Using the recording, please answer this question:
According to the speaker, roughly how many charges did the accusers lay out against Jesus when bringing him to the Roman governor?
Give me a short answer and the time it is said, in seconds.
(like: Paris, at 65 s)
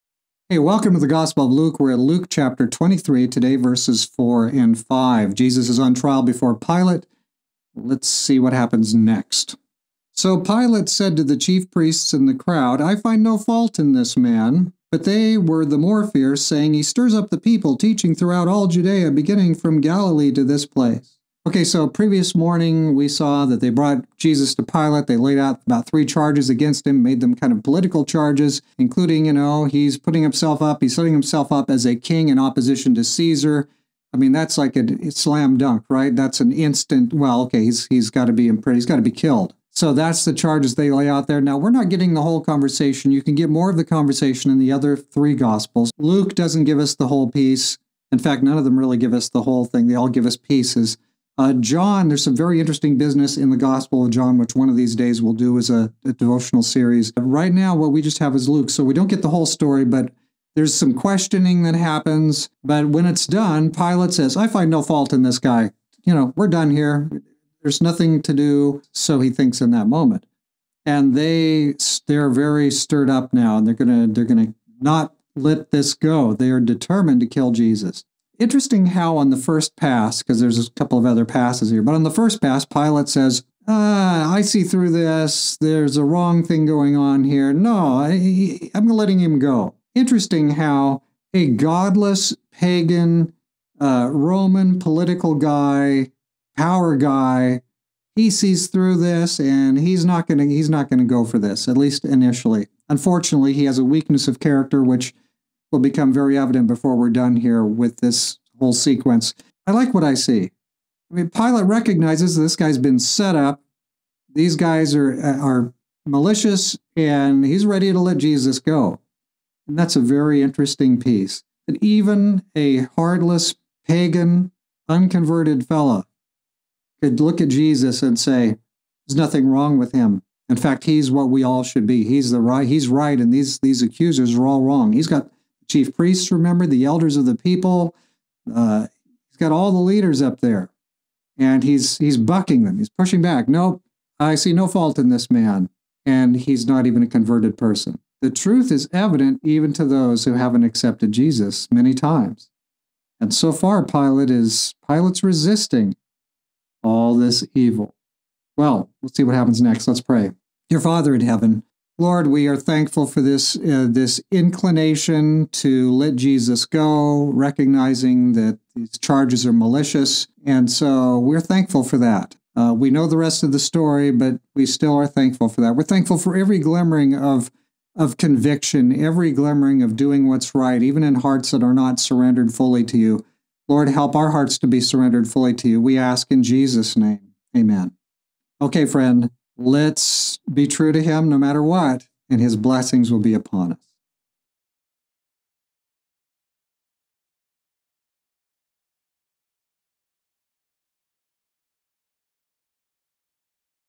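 3, at 25 s.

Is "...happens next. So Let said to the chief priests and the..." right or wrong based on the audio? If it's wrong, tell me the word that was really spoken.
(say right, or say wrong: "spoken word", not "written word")
wrong: "Pilate", not "Let".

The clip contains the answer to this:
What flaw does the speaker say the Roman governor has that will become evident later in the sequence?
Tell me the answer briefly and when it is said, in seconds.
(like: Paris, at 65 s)
Weakness of character, at 103 s.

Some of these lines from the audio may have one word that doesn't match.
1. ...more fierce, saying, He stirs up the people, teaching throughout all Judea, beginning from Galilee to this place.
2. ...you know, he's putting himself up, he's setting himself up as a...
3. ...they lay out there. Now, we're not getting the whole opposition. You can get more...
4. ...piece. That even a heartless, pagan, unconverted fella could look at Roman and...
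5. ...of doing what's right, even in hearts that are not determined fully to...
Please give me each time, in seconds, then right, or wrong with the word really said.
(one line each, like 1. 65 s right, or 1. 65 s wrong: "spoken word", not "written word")
1. 15 s right
2. 29 s right
3. 40 s wrong: "conversation", not "opposition"
4. 120 s wrong: "Jesus", not "Roman"
5. 179 s wrong: "surrendered", not "determined".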